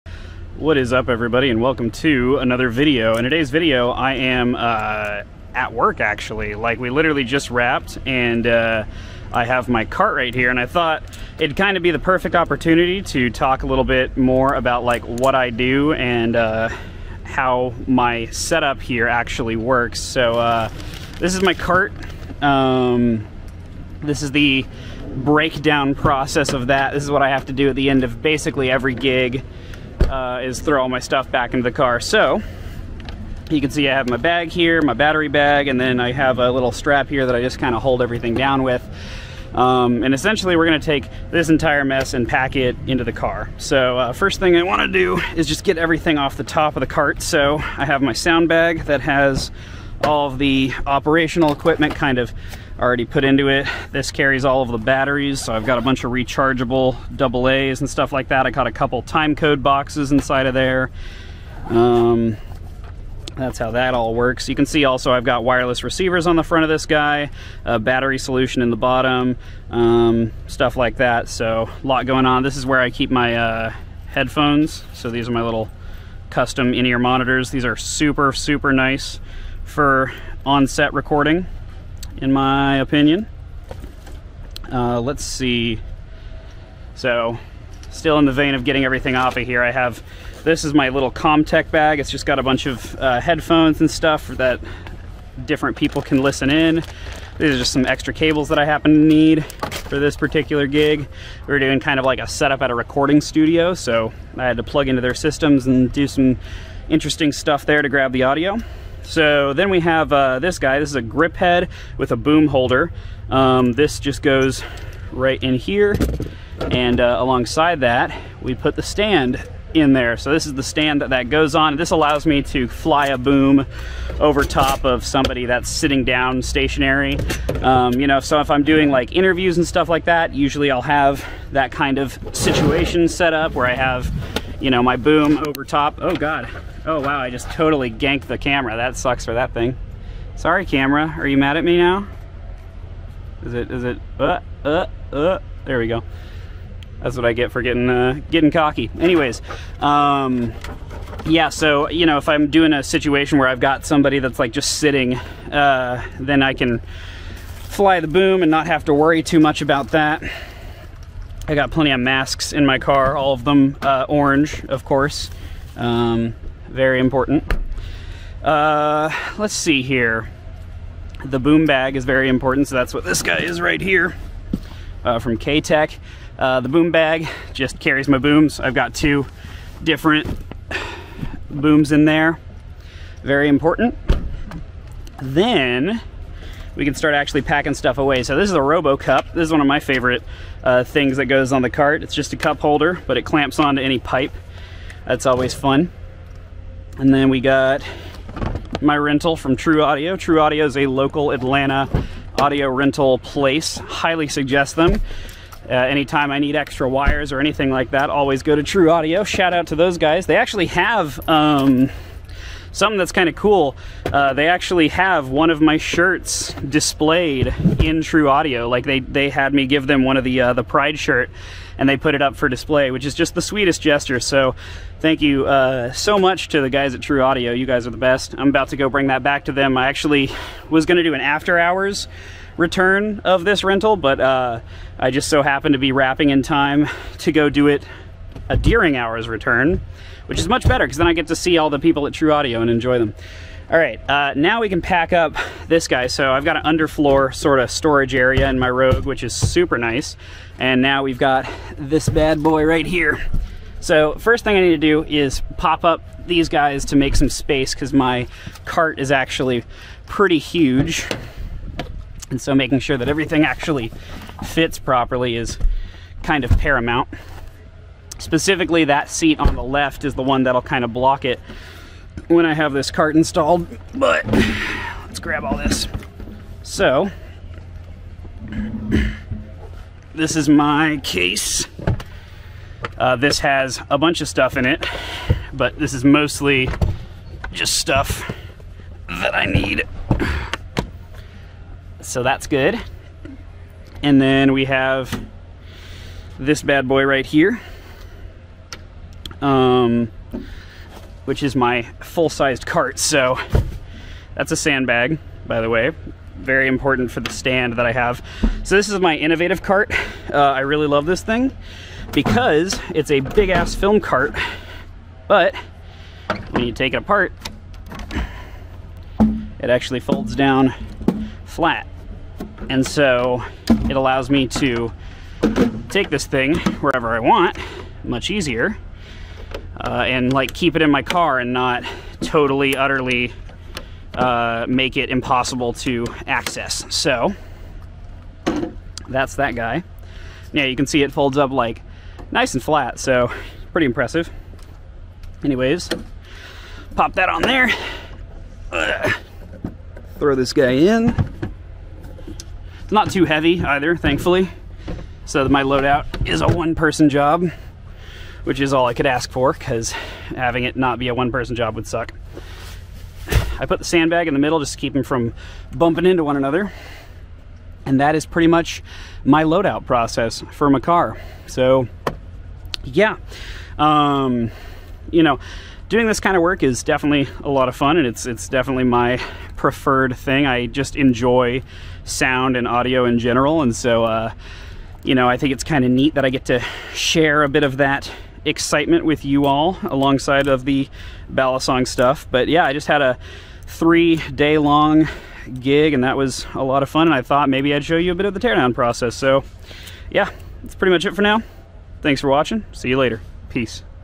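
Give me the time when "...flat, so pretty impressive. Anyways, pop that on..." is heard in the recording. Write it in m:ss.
5:42.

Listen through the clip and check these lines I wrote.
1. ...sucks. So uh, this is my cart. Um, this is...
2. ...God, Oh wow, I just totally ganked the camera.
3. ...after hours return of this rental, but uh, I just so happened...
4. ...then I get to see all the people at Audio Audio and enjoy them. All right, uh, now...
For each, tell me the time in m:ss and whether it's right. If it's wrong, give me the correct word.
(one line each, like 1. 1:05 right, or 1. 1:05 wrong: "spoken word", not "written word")
1. 0:19 wrong: "works", not "sucks"
2. 2:16 right
3. 3:51 right
4. 4:00 wrong: "Trew", not "Audio".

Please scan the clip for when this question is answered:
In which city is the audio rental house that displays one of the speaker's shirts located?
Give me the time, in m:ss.
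3:21.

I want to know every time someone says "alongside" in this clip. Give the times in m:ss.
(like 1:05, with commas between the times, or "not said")
1:57, 6:29.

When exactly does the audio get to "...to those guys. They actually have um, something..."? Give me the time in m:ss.
3:29.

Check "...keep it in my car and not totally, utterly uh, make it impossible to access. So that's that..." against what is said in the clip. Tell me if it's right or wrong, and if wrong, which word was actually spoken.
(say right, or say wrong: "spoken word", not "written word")
right.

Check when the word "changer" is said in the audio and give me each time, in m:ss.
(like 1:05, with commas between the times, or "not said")
not said.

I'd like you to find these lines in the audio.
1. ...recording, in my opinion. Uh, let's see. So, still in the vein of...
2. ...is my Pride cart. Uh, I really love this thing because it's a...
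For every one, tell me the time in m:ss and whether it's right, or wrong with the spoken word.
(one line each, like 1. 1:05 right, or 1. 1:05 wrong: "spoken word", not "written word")
1. 1:20 right
2. 5:08 wrong: "Inovativ", not "Pride".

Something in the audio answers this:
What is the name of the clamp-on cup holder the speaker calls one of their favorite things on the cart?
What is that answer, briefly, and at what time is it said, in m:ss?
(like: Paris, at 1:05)
RoboCup, at 3:08.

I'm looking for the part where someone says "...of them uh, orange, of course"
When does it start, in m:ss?
2:43.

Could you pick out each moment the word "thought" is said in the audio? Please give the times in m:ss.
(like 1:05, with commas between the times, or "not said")
0:10, 6:37.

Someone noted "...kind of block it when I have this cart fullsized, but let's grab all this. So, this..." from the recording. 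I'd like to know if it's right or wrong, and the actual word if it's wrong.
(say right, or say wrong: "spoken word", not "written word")
wrong: "installed", not "fullsized".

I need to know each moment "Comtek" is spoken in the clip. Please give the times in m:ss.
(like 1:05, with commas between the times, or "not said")
1:31.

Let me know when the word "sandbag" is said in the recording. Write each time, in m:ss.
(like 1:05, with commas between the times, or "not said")
5:04, 6:03.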